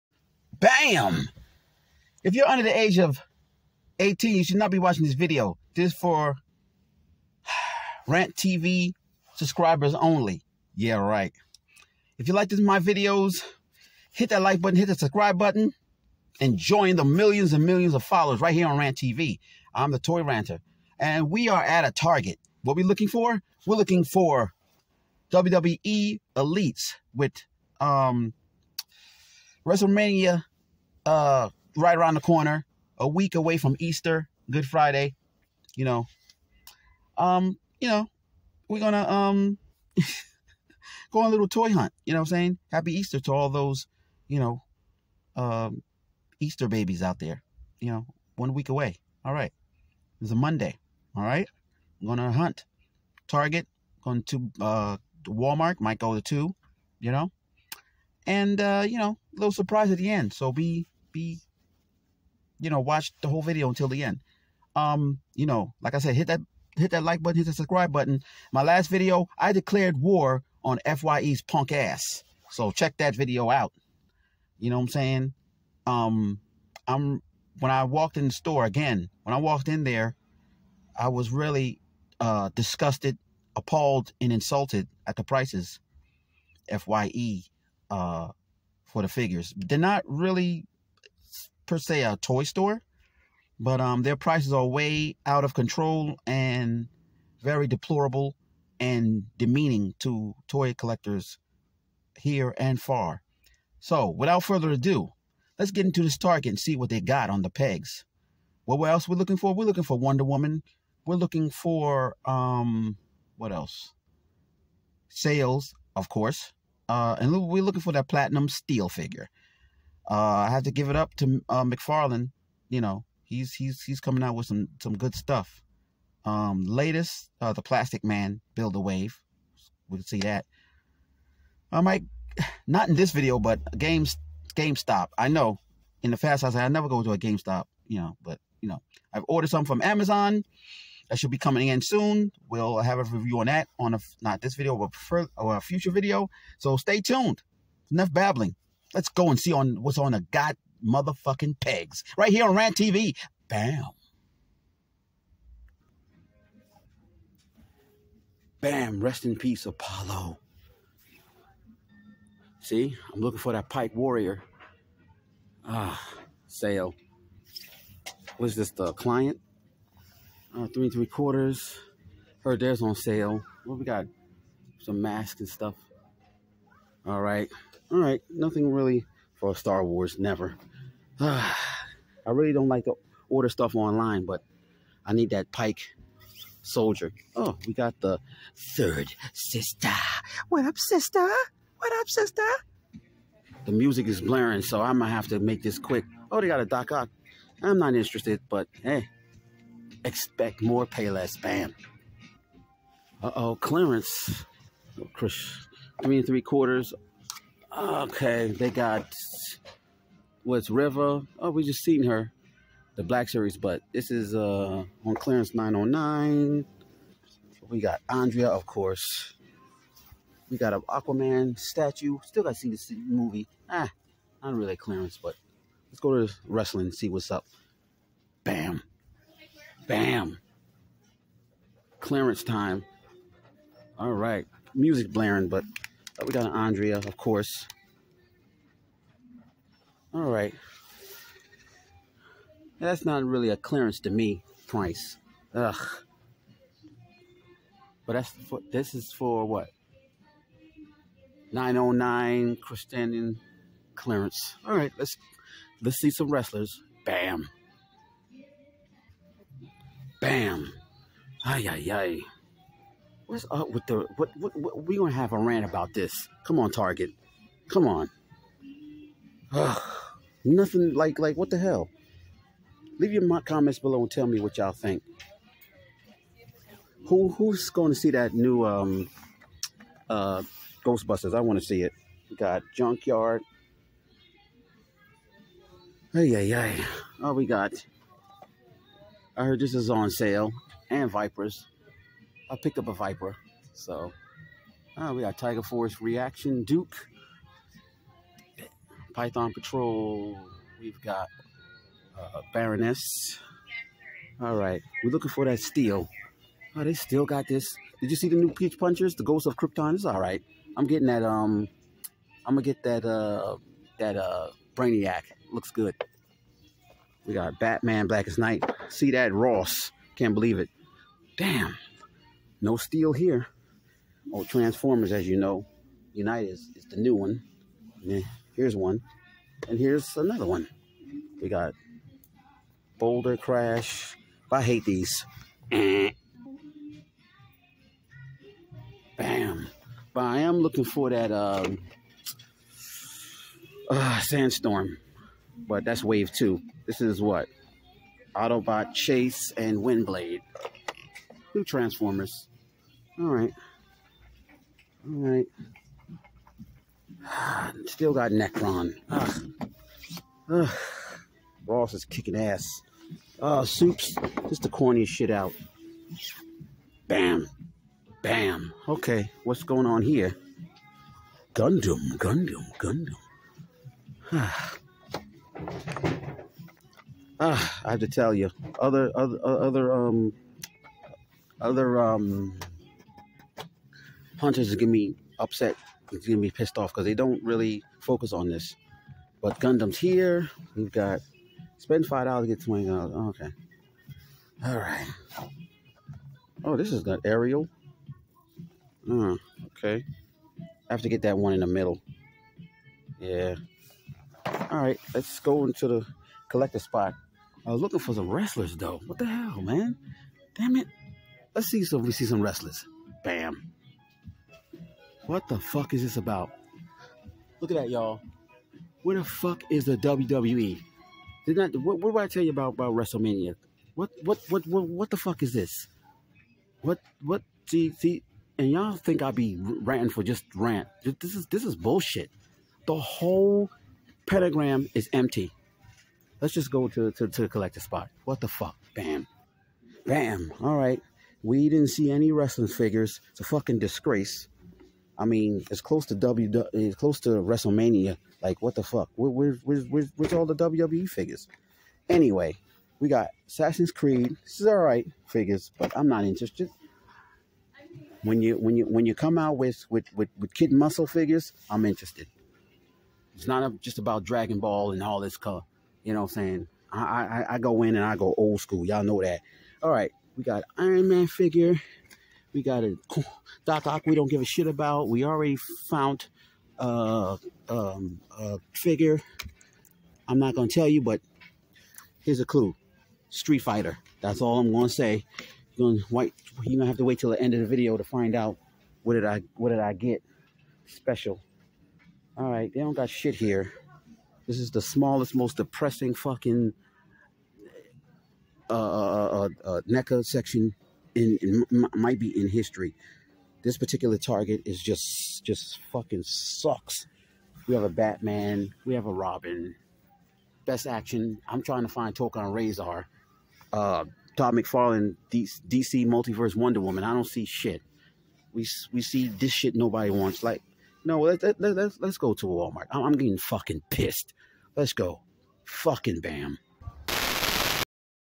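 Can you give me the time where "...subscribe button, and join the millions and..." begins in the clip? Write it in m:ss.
0:14.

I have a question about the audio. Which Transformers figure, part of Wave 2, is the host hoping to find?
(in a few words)
Sandstorm.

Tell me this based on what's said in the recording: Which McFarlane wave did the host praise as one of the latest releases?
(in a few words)
Plastic Man build a wave.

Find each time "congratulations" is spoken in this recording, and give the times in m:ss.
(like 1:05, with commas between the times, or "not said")
not said.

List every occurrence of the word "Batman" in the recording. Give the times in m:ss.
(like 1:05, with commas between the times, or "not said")
5:17, 8:27.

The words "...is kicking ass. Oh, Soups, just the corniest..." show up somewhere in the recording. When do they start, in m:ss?
6:01.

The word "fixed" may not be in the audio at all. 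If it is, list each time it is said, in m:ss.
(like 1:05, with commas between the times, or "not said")
not said.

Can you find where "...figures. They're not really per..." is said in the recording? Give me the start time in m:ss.
1:29.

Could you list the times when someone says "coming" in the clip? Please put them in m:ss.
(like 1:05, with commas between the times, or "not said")
2:04, 2:21.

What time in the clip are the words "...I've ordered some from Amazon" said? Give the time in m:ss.
2:19.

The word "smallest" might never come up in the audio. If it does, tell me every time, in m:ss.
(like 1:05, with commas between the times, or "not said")
8:14.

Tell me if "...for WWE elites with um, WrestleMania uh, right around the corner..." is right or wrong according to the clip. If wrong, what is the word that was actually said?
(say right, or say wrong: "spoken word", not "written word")
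right.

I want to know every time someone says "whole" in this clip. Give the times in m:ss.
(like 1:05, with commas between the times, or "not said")
1:03, 7:12.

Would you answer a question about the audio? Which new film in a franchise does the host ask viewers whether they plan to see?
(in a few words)
Ghostbusters.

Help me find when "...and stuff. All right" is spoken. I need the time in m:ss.
2:55.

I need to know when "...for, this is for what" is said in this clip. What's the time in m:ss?
4:08.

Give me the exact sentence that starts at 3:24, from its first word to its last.
Oh, Chris, three and three quarters.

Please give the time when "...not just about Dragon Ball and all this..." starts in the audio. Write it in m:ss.
7:43.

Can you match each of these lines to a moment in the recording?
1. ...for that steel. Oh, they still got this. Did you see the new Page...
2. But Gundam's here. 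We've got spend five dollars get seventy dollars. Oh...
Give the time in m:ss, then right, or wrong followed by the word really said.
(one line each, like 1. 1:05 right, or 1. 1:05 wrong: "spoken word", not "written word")
1. 5:05 right
2. 6:29 wrong: "twenty", not "seventy".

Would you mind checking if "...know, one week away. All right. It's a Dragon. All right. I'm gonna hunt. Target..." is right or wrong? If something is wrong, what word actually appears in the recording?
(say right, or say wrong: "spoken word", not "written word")
wrong: "Monday", not "Dragon".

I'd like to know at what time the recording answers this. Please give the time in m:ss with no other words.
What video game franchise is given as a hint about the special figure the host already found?
8:03.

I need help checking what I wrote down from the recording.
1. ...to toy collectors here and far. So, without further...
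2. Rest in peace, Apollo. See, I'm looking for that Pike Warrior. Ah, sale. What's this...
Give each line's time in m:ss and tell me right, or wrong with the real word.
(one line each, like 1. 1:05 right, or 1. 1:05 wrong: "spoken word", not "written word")
1. 1:39 right
2. 2:39 right.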